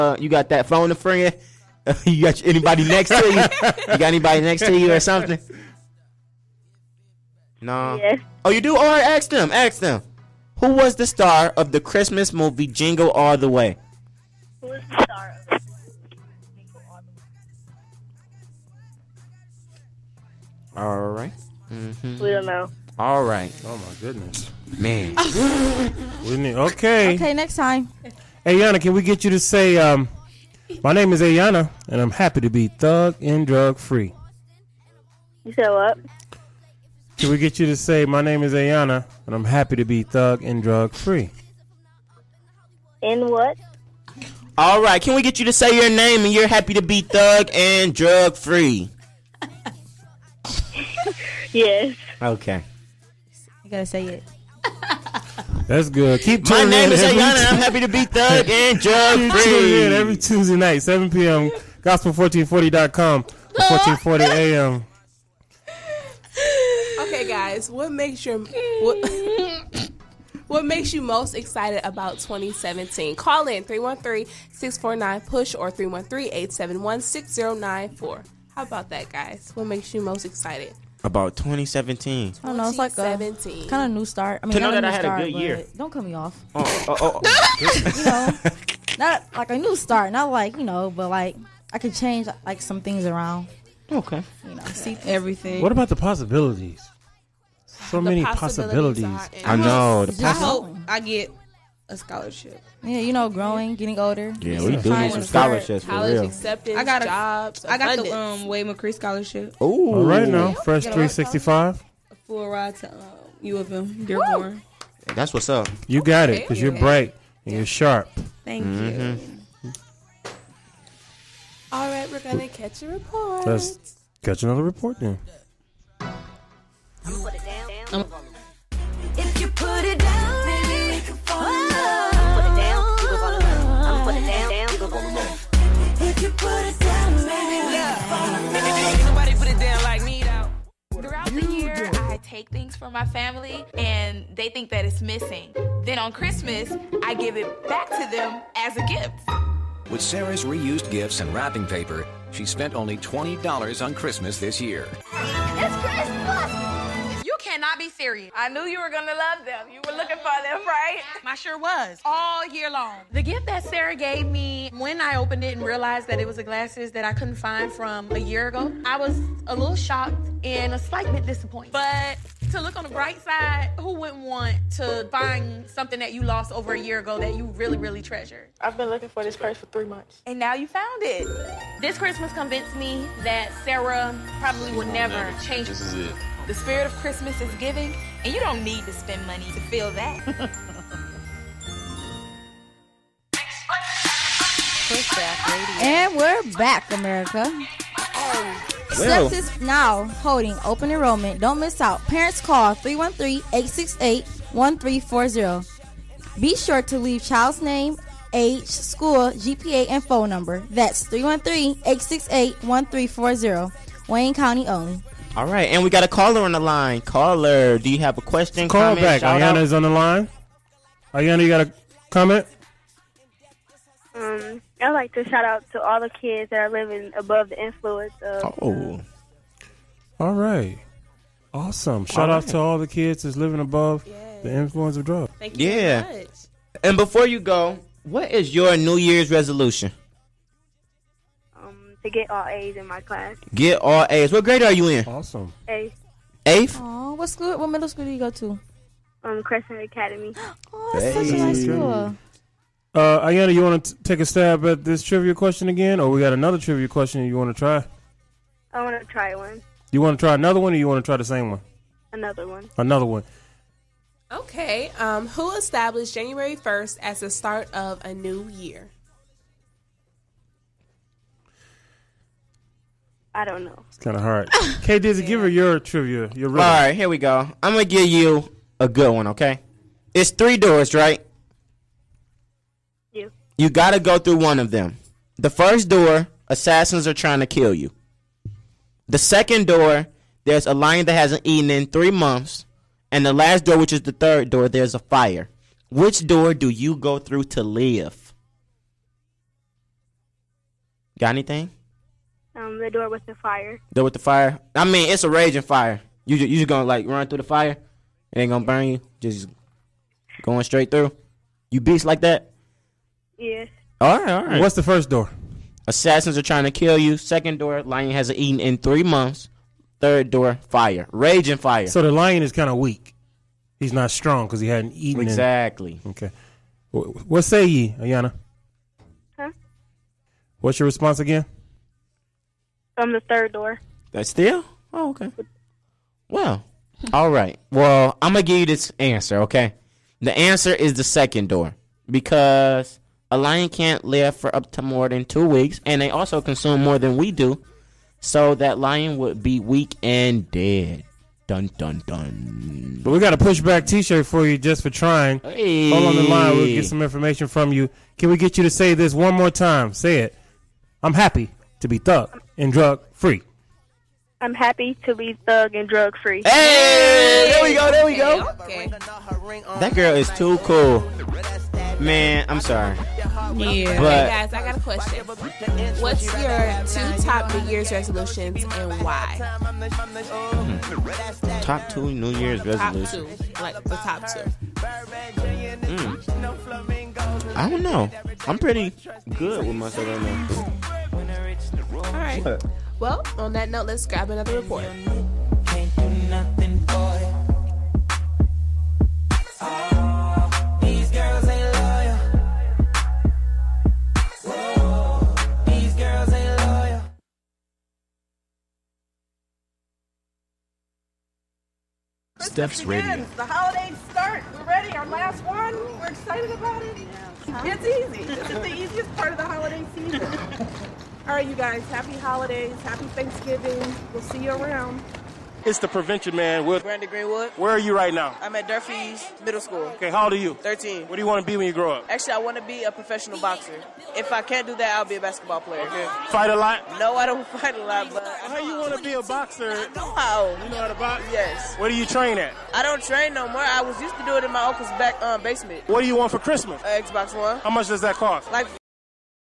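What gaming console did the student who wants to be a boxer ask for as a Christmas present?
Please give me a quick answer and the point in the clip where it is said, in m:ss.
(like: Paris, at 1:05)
Xbox One, at 7:27.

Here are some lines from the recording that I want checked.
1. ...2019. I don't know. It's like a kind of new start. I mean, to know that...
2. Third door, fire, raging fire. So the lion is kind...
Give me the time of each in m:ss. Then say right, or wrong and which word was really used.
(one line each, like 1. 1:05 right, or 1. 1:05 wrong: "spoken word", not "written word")
1. 1:21 wrong: "2017", not "2019"
2. 5:19 right.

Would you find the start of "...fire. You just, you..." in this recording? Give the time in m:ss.
5:05.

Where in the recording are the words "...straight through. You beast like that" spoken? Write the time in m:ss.
5:10.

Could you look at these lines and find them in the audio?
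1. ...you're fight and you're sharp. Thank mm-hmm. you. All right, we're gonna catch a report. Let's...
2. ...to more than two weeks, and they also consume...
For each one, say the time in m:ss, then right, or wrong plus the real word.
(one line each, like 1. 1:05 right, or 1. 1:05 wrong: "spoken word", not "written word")
1. 1:56 wrong: "bright", not "fight"
2. 5:44 right.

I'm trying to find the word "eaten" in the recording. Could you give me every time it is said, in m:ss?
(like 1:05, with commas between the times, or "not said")
4:51, 5:18, 5:24.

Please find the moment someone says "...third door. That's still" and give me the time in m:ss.
5:33.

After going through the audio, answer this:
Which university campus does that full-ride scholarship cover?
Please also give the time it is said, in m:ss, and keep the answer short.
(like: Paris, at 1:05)
U of M, Dearborn, at 1:53.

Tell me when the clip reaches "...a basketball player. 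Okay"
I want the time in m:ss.
7:15.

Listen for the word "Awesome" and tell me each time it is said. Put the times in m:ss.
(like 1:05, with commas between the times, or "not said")
3:51, 4:05.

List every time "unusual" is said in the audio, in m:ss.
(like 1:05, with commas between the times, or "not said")
not said.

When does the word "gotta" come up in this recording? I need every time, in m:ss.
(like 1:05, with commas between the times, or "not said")
0:53, 4:43.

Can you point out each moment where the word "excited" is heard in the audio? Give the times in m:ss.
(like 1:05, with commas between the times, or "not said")
1:11, 1:20, 6:56.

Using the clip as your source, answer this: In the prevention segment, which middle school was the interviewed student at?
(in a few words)
Durfee's Middle School.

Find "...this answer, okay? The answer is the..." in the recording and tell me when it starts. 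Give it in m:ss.
5:38.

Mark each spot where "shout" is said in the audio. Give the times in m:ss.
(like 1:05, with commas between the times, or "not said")
3:45, 3:52.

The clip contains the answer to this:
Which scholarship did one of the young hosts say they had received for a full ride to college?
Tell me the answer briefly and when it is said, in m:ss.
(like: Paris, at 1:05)
Wade McCree scholarship, at 1:48.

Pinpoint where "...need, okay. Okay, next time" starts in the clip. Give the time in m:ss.
0:26.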